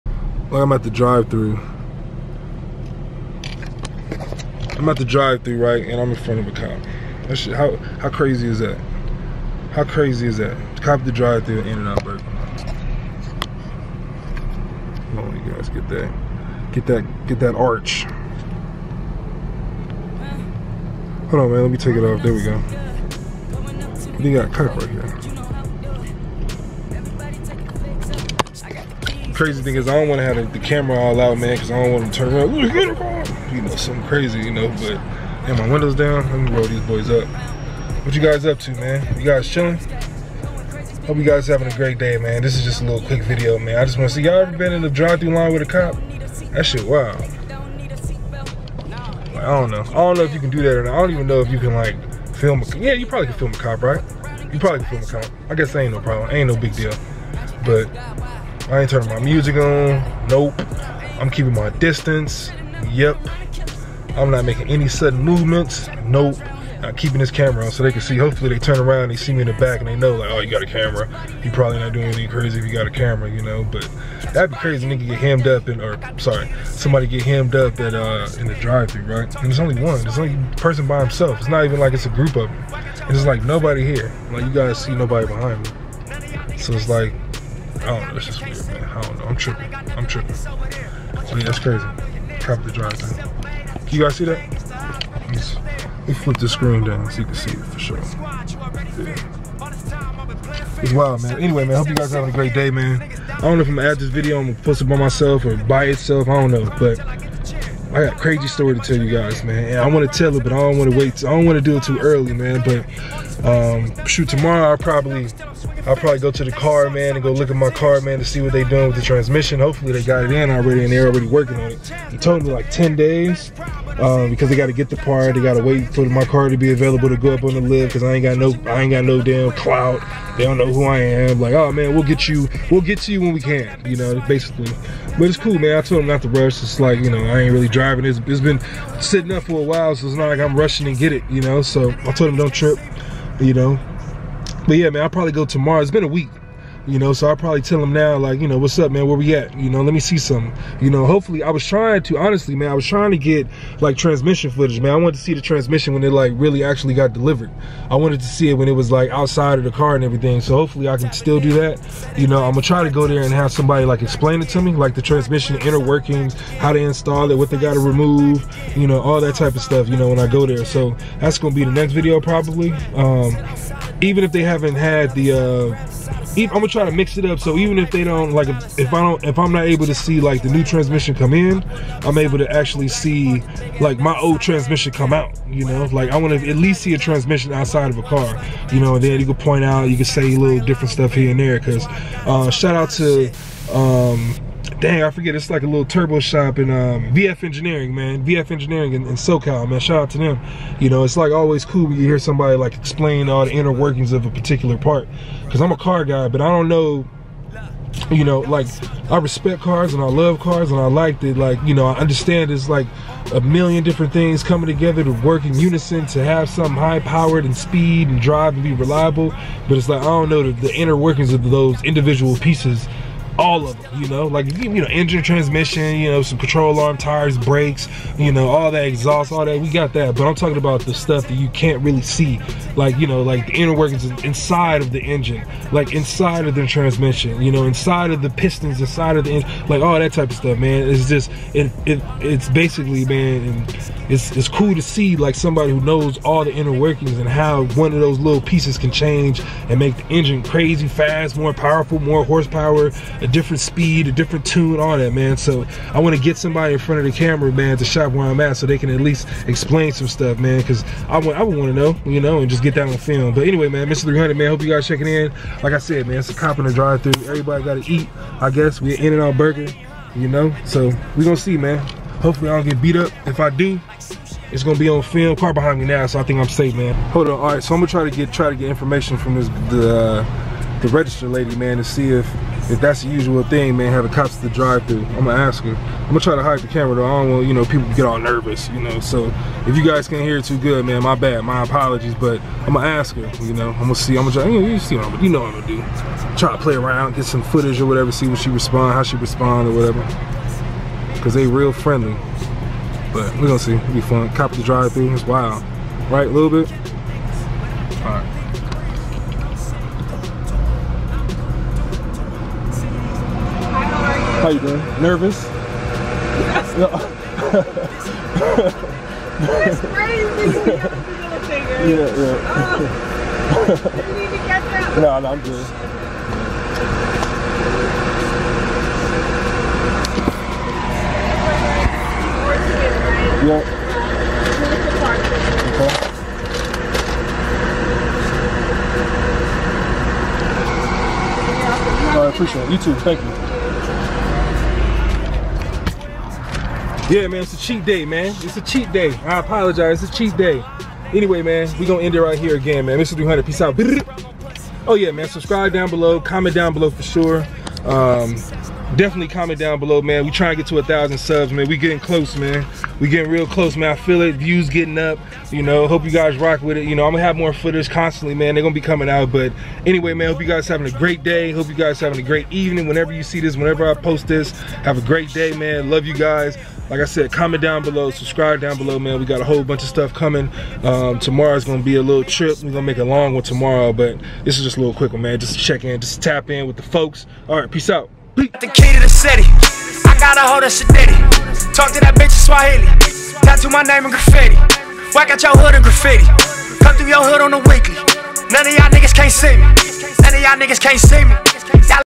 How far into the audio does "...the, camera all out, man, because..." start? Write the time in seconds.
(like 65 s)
30 s.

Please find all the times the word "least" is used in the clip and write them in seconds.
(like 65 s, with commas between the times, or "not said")
186 s, 259 s.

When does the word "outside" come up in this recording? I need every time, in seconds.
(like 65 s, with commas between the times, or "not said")
159 s, 187 s.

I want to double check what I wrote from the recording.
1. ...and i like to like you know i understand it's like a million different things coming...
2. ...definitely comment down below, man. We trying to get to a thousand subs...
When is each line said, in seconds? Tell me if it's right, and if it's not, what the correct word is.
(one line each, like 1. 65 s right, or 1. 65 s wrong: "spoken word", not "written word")
1. 210 s right
2. 358 s right.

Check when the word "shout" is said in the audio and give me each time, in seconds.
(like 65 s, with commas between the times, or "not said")
192 s, 199 s.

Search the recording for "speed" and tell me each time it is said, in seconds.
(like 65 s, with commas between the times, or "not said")
217 s, 253 s.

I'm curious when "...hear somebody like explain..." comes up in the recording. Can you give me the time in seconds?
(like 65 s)
202 s.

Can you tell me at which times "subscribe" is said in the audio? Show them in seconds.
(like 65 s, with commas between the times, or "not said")
355 s, 378 s.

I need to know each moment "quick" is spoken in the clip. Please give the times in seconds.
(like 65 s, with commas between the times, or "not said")
43 s, 384 s.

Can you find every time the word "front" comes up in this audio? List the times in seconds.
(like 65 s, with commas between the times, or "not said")
6 s, 256 s.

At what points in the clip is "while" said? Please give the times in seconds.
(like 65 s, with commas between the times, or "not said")
139 s.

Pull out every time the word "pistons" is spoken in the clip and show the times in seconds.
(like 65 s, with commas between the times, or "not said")
238 s.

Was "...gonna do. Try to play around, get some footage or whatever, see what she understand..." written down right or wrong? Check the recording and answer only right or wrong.
wrong.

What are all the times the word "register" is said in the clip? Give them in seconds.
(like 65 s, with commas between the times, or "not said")
280 s.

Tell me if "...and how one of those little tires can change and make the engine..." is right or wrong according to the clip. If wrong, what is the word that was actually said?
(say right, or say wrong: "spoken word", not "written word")
wrong: "pieces", not "tires".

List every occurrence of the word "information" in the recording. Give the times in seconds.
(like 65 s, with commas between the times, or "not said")
278 s.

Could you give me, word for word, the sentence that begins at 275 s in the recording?
Car behind me now, so I think I'm safe, man.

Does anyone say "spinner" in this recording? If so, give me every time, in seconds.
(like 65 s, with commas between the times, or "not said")
not said.